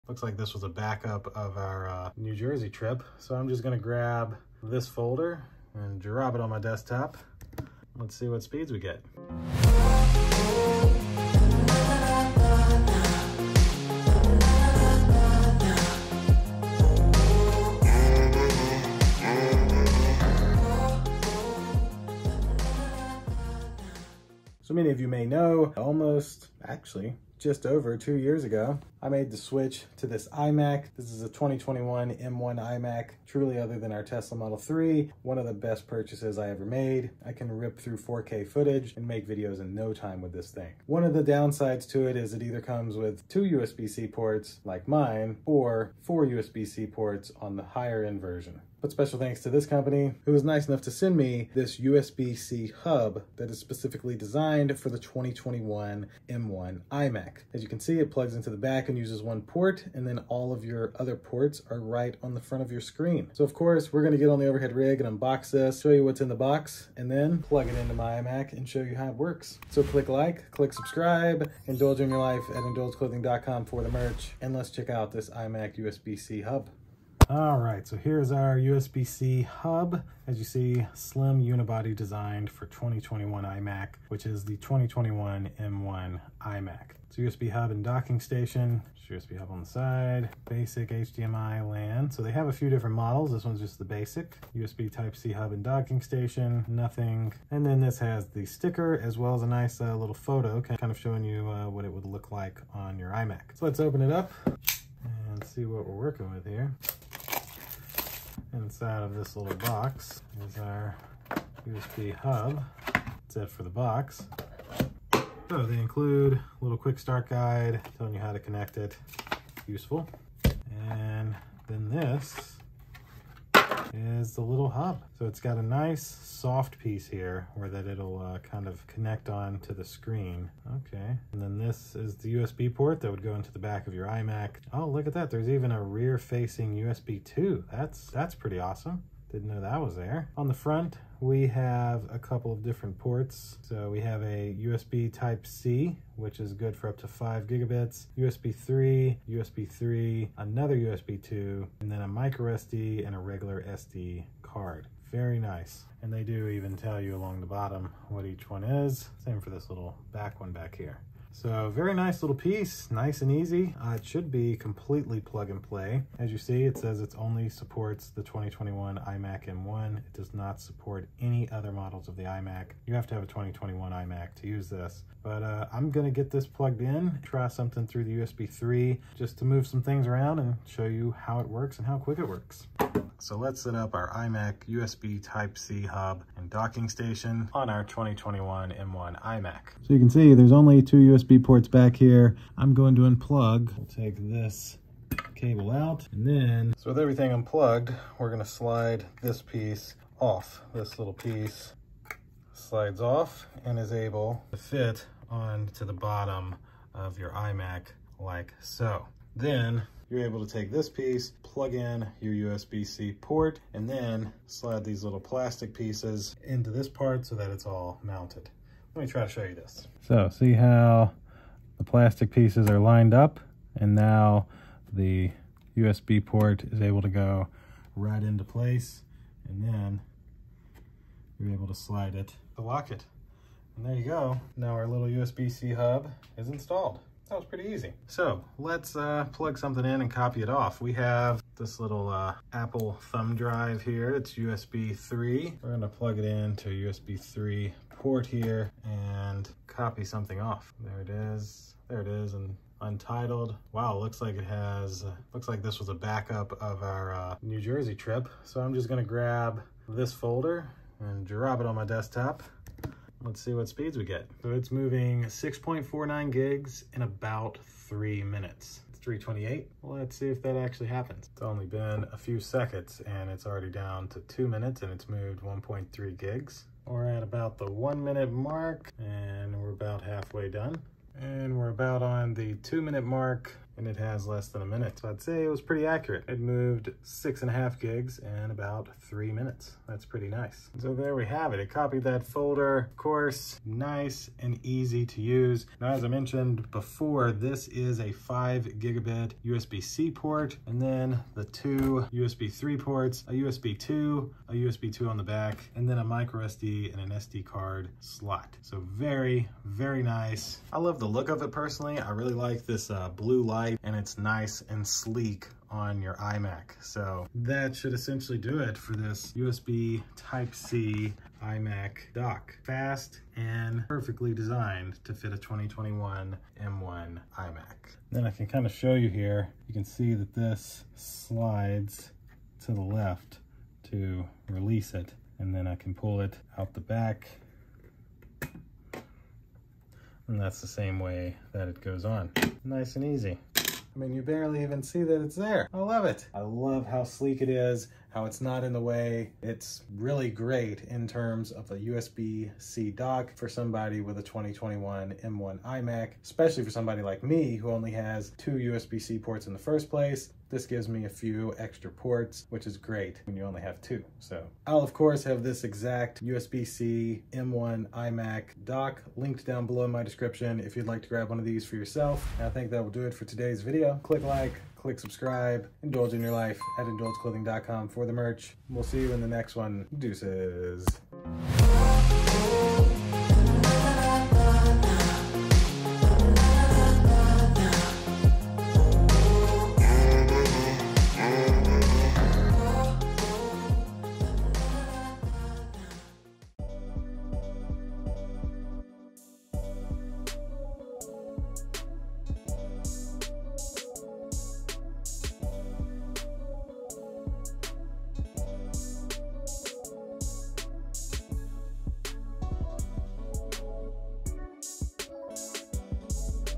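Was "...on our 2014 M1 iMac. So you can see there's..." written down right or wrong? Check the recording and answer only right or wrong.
wrong.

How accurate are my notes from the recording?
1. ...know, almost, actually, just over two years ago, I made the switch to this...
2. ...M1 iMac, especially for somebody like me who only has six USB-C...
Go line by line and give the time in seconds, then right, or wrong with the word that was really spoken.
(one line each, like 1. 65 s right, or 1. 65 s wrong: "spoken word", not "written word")
1. 25 s right
2. 355 s wrong: "two", not "six".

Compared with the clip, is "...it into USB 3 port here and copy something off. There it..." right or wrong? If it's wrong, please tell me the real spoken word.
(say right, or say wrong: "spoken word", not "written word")
right.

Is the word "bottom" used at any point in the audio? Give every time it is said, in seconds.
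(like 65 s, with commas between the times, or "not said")
157 s, 205 s.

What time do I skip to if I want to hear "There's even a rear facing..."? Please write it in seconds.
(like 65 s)
135 s.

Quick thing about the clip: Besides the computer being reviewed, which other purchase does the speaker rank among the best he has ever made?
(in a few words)
Tesla Model 3.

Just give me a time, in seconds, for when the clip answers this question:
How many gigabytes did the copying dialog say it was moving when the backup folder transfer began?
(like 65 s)
265 s.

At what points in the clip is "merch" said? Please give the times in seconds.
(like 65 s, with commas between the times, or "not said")
73 s, 378 s.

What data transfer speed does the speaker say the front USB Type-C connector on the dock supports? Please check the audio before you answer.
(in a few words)
5 gigabits.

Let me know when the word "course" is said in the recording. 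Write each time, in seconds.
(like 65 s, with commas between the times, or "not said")
63 s, 292 s, 364 s.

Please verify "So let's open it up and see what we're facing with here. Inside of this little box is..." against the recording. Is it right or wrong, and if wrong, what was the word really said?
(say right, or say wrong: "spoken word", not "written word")
wrong: "working", not "facing".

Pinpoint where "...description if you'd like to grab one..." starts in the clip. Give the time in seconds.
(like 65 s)
370 s.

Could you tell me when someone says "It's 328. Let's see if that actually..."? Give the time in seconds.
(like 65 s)
268 s.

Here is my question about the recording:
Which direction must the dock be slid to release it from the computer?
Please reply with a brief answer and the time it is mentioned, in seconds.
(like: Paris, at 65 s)
left, at 332 s.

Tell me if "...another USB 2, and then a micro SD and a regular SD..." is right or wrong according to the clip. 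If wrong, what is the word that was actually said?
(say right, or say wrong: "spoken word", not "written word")
right.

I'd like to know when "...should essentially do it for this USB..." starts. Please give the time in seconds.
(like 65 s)
317 s.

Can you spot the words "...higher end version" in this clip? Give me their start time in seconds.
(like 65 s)
47 s.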